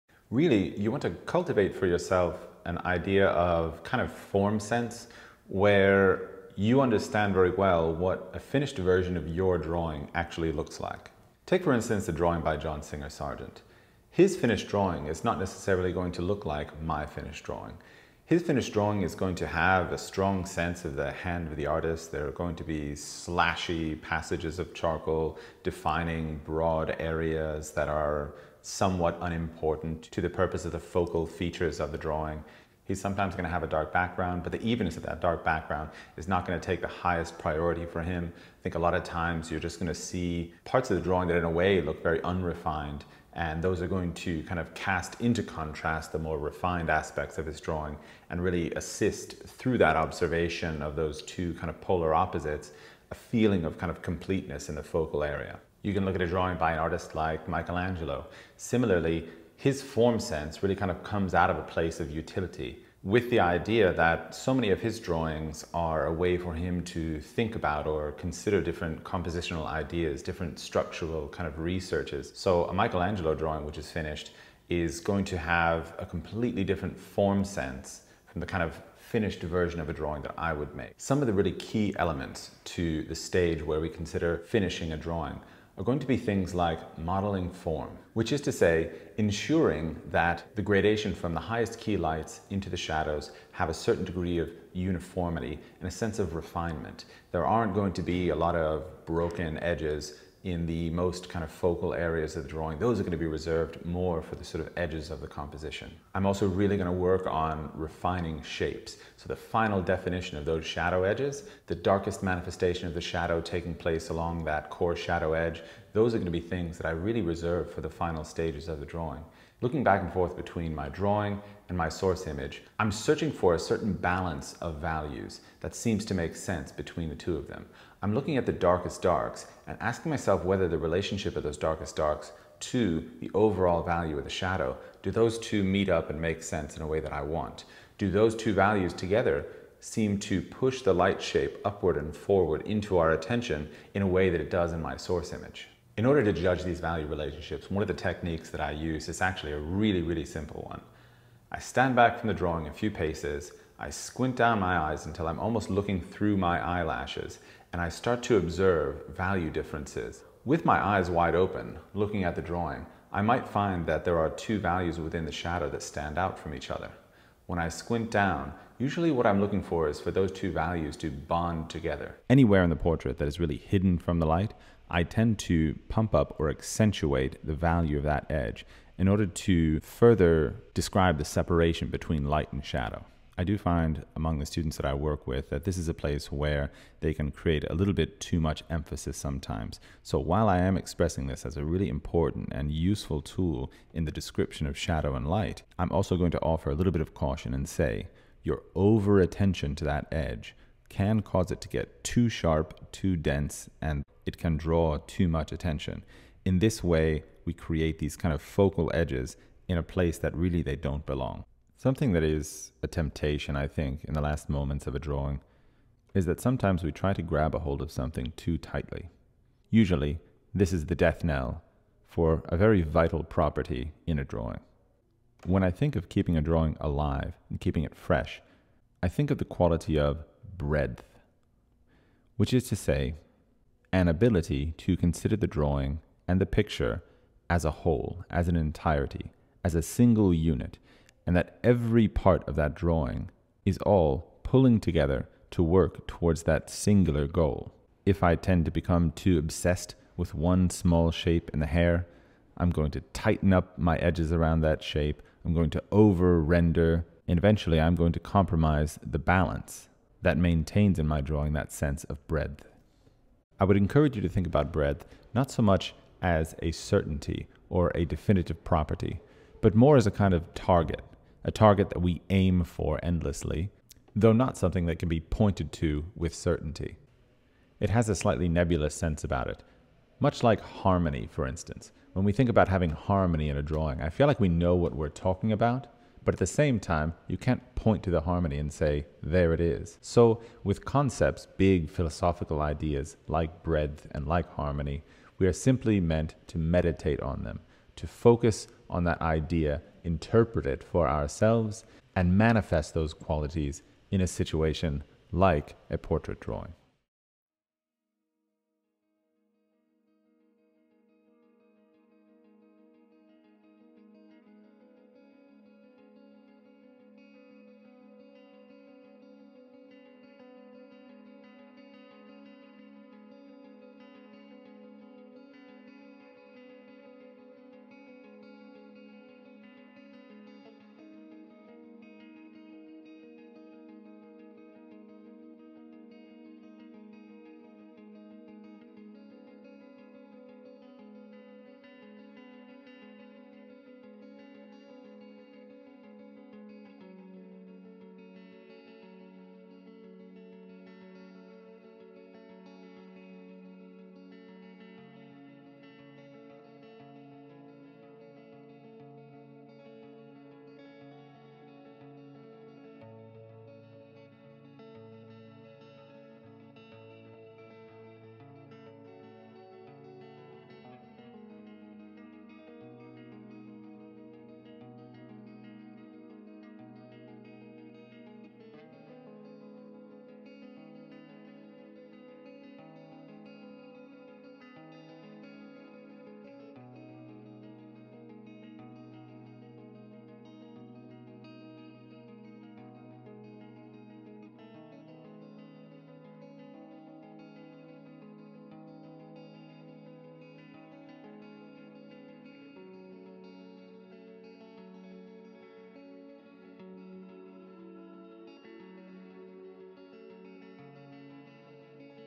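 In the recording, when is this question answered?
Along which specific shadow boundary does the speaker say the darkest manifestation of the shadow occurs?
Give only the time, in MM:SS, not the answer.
01:54.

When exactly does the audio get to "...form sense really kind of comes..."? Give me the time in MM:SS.
00:59.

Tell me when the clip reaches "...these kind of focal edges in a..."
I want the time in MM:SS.
03:27.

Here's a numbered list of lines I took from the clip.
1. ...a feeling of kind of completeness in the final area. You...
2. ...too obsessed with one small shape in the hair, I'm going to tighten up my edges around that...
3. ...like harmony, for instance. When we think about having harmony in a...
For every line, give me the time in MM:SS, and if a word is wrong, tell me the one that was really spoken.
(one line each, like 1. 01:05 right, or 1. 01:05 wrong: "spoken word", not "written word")
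1. 00:53 wrong: "focal", not "final"
2. 04:09 right
3. 04:40 right.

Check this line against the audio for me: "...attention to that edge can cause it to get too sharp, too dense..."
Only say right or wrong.
right.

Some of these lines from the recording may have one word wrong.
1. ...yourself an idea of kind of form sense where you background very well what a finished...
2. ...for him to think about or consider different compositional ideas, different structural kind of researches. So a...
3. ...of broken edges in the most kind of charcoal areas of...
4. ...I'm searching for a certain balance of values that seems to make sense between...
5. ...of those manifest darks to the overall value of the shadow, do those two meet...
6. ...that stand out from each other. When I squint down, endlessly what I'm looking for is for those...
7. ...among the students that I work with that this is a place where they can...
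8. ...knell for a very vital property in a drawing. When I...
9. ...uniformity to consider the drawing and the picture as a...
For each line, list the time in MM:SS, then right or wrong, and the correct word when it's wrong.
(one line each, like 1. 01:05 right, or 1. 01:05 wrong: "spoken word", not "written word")
1. 00:01 wrong: "understand", not "background"
2. 01:06 right
3. 01:38 wrong: "focal", not "charcoal"
4. 02:02 right
5. 02:11 wrong: "darkest", not "manifest"
6. 02:45 wrong: "usually", not "endlessly"
7. 03:04 right
8. 03:41 right
9. 03:54 wrong: "ability", not "uniformity".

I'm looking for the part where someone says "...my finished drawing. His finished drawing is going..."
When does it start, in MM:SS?
00:16.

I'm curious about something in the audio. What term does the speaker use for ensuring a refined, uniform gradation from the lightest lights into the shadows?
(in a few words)
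modeling form.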